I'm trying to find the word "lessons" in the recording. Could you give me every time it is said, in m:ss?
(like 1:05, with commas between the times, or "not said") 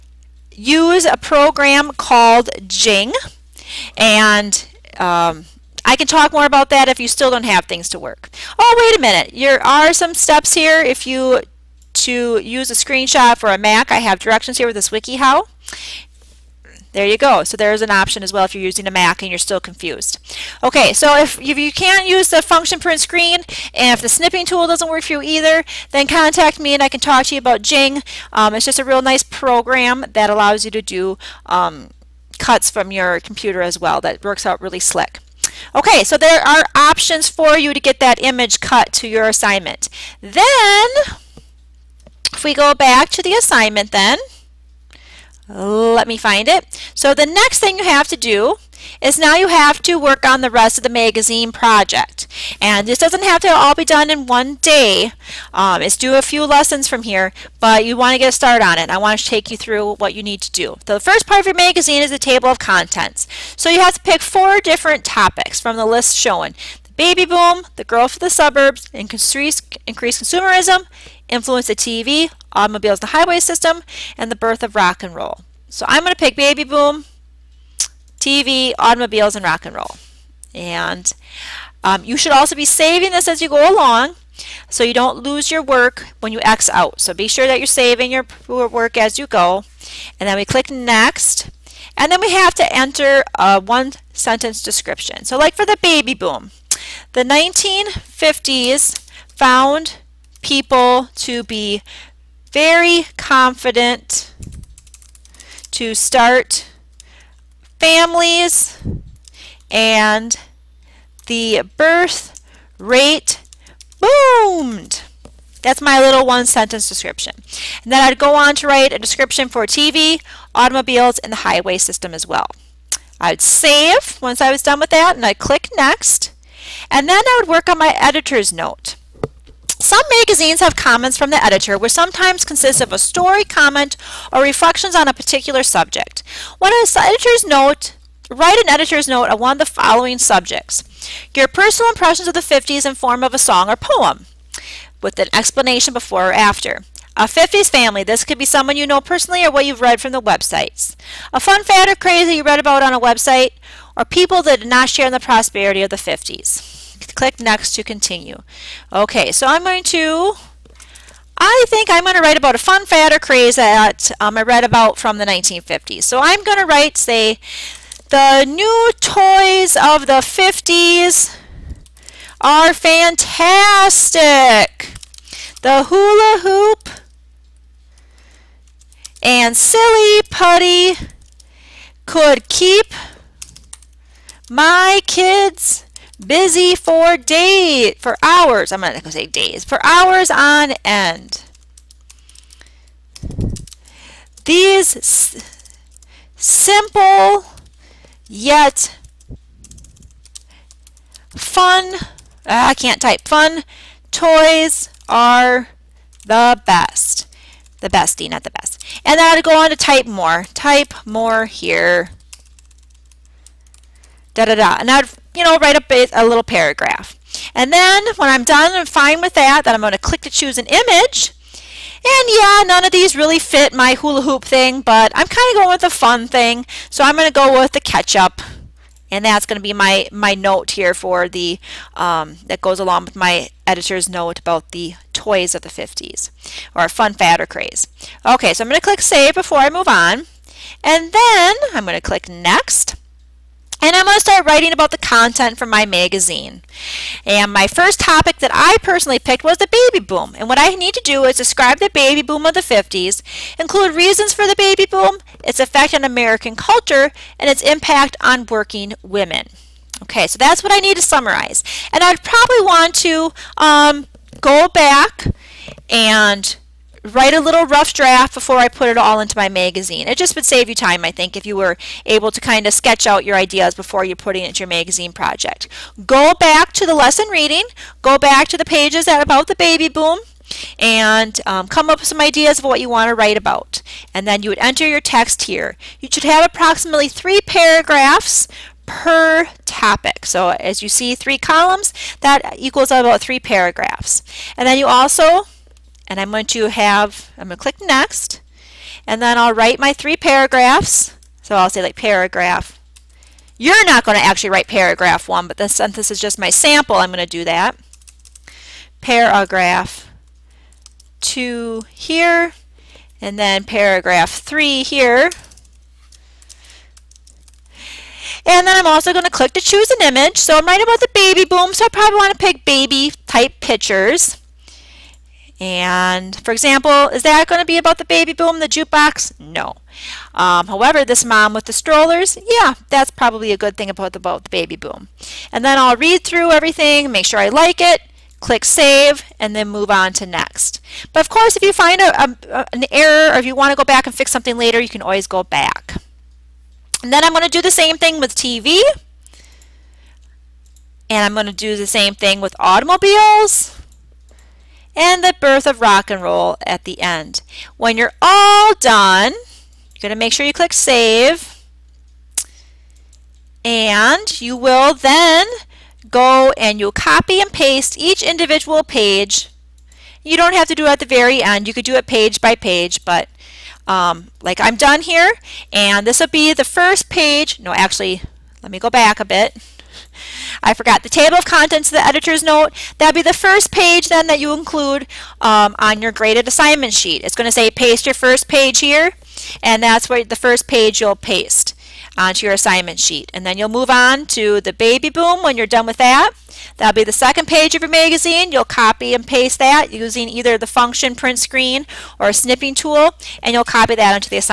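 0:56, 4:36.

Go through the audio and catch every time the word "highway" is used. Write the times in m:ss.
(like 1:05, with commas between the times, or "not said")
1:13, 2:01.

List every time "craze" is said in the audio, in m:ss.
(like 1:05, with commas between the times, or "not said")
2:31, 2:43, 3:57.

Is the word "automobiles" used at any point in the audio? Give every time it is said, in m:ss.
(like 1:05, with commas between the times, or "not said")
1:12, 1:18, 2:00, 5:52.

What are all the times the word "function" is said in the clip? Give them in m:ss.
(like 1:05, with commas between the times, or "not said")
0:22, 6:40.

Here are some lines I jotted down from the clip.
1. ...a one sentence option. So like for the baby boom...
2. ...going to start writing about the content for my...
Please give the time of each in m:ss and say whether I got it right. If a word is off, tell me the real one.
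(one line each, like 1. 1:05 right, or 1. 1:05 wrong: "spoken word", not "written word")
1. 1:33 wrong: "description", not "option"
2. 4:04 right.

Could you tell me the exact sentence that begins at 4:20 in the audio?
Okay, so that's what I need to summarize.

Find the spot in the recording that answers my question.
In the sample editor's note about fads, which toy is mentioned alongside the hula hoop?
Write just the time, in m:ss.
2:59.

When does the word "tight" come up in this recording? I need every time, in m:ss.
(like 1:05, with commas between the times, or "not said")
not said.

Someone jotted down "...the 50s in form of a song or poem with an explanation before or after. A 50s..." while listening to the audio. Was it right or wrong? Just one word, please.
right.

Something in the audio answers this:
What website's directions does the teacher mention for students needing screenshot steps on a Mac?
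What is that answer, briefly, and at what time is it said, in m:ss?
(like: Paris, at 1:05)
WikiHow, at 0:14.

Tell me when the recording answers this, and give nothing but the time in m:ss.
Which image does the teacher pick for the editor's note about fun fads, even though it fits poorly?
3:47.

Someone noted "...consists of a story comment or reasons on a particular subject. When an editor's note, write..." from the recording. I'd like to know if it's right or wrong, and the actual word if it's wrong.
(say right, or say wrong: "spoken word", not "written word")
wrong: "reflections", not "reasons".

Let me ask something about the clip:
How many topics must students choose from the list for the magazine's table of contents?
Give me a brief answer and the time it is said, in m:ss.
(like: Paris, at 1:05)
4, at 1:04.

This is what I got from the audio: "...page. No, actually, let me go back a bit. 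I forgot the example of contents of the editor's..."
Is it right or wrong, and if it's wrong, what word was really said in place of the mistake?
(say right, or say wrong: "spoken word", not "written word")
wrong: "table", not "example".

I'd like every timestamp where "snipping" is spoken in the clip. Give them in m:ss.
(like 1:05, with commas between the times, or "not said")
0:24, 6:42.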